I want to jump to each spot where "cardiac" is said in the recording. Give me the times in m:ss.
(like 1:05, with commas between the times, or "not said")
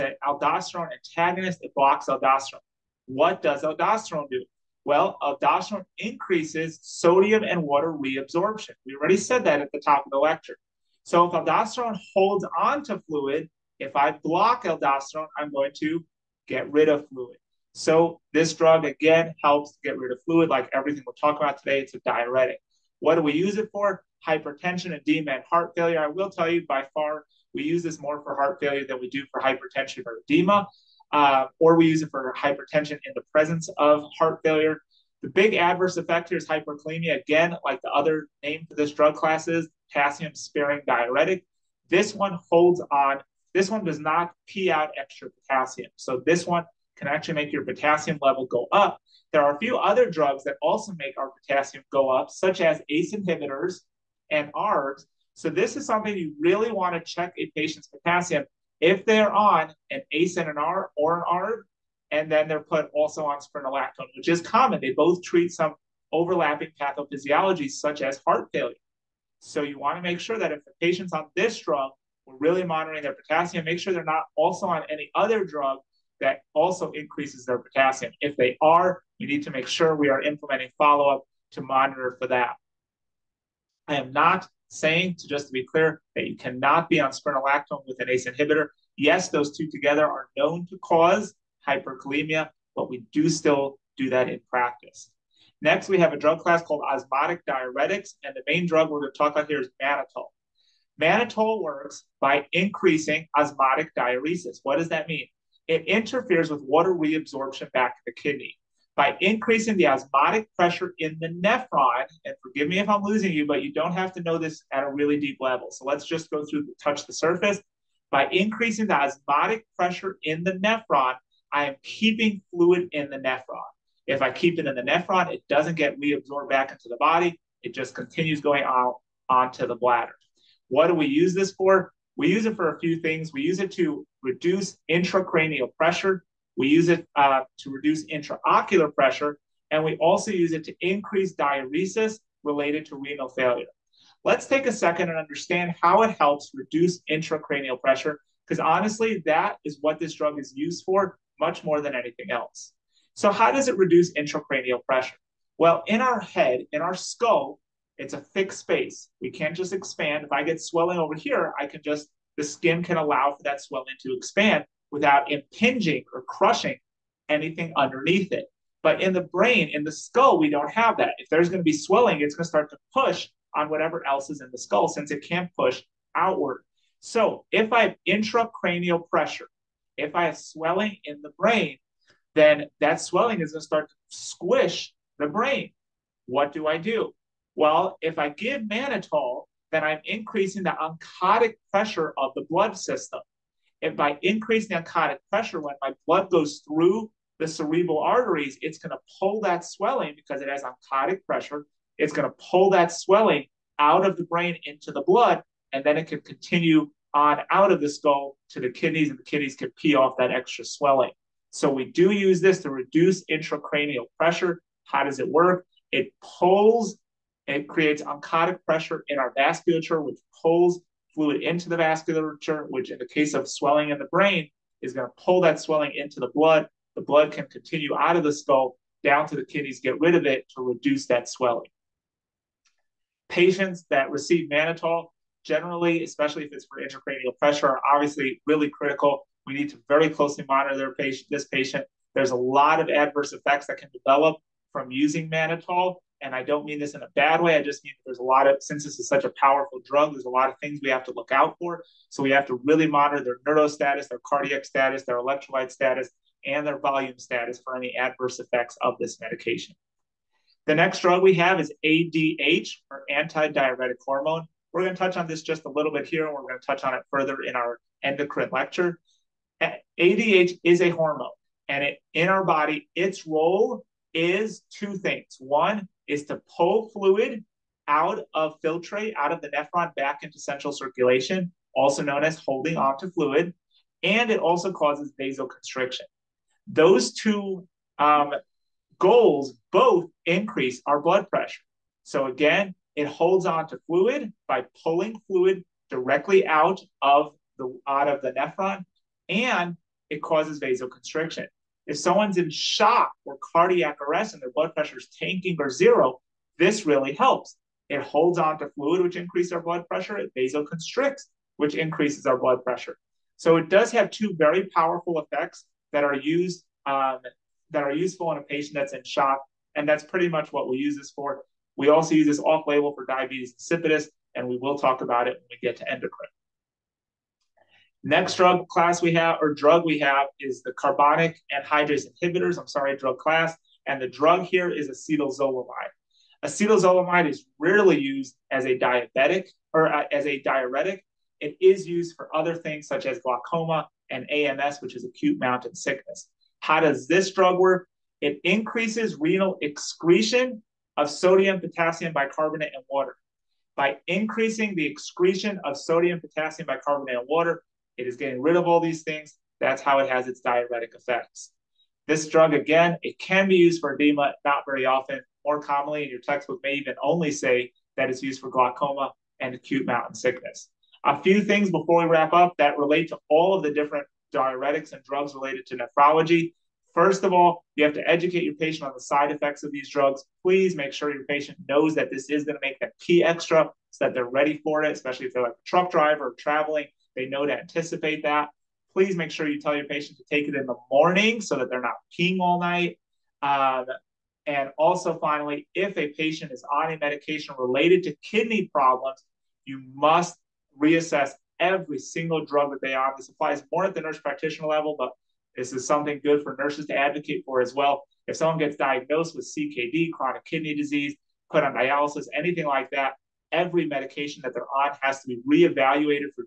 4:14, 5:03.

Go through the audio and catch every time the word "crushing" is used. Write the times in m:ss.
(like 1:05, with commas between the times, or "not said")
2:46.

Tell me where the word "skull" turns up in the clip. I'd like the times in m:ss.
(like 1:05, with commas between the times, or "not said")
2:36, 2:49, 2:54, 3:27, 3:48.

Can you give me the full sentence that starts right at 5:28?
Next drug class we have, or drug we have, is the carbonic anhydrase inhibitors.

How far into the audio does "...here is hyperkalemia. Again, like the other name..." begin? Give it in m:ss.
0:36.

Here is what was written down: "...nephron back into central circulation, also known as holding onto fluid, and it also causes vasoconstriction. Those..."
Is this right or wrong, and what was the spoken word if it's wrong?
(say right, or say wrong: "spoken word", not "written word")
right.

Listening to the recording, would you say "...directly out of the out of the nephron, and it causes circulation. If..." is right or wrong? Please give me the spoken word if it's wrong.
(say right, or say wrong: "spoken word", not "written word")
wrong: "vasoconstriction", not "circulation".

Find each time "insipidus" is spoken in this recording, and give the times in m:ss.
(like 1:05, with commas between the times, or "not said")
5:23.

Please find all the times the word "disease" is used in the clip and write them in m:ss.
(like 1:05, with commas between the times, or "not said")
6:50.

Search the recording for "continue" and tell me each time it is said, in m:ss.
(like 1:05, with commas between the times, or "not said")
2:07, 3:26, 3:47.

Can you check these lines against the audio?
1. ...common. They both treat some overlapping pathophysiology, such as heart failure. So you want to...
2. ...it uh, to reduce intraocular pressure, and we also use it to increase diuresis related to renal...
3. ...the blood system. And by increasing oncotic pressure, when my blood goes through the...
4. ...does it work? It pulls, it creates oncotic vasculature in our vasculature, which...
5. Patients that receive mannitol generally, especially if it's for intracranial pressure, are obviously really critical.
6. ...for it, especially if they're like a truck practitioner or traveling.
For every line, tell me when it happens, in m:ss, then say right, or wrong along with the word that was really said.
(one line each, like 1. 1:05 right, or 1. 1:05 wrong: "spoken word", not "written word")
1. 1:04 right
2. 2:16 right
3. 3:12 right
4. 3:35 wrong: "pressure", not "vasculature"
5. 3:53 right
6. 6:24 wrong: "driver", not "practitioner".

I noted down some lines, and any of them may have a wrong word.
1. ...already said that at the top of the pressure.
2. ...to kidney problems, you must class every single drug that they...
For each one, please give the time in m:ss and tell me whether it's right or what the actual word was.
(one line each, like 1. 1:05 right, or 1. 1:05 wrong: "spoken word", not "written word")
1. 0:08 wrong: "lecture", not "pressure"
2. 6:38 wrong: "reassess", not "class".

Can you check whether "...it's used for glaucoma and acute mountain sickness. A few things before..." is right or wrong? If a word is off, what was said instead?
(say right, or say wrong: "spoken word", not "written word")
right.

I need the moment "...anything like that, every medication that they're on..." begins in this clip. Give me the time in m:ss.
6:52.